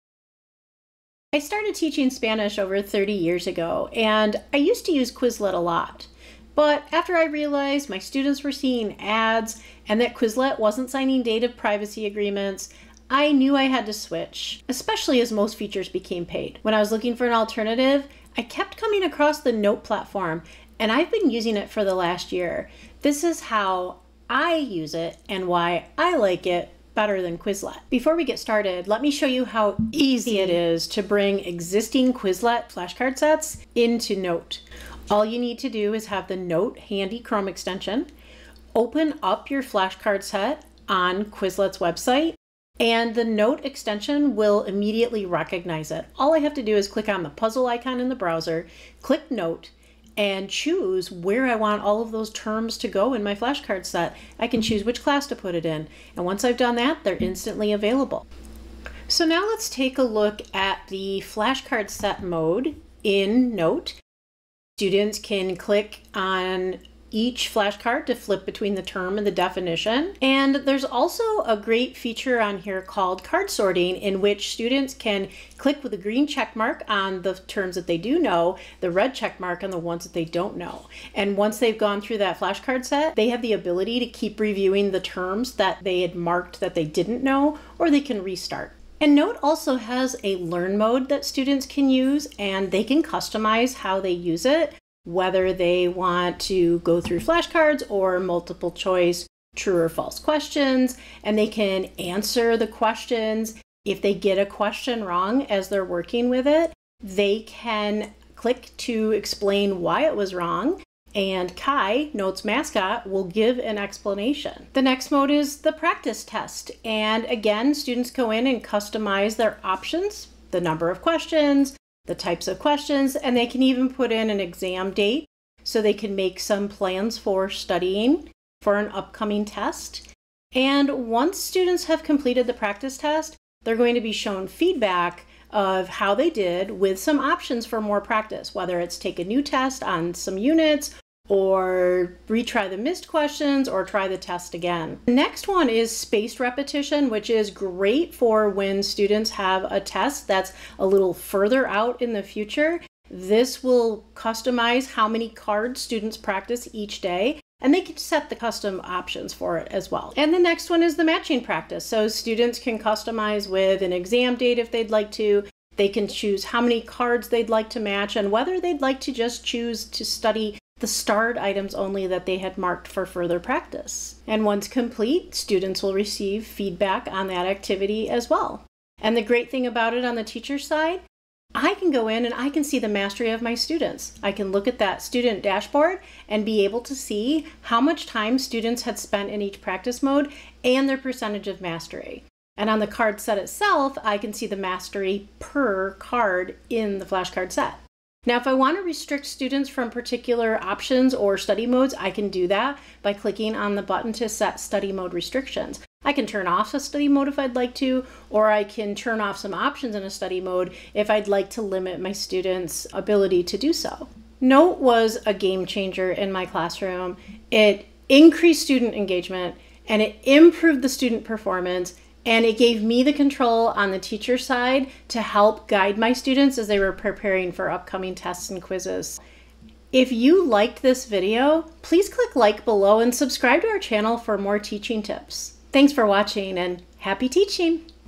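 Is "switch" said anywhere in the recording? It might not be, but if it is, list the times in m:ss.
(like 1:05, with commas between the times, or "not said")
0:13.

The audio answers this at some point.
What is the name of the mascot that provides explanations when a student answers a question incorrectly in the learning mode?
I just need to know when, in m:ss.
1:51.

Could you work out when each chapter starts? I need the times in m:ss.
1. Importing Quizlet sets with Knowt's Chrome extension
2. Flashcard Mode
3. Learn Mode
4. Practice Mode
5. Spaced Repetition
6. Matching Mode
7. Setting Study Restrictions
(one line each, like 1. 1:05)
1. 0:28
2. 0:59
3. 1:29
4. 1:55
5. 2:26
6. 2:40
7. 3:21.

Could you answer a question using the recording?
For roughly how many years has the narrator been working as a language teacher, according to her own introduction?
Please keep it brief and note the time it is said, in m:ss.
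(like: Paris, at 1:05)
over 30 years, at 0:02.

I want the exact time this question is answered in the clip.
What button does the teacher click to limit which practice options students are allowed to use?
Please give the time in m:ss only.
3:24.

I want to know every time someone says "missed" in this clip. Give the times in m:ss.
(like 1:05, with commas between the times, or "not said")
2:22.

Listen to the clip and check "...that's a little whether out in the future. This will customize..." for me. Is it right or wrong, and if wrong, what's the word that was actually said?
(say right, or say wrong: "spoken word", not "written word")
wrong: "further", not "whether".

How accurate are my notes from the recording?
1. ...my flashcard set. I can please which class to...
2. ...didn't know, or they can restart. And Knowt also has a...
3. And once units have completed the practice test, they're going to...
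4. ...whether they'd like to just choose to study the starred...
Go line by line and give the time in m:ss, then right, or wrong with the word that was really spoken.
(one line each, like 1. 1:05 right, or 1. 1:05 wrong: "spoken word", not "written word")
1. 0:53 wrong: "choose", not "please"
2. 1:26 right
3. 2:10 wrong: "students", not "units"
4. 2:48 right.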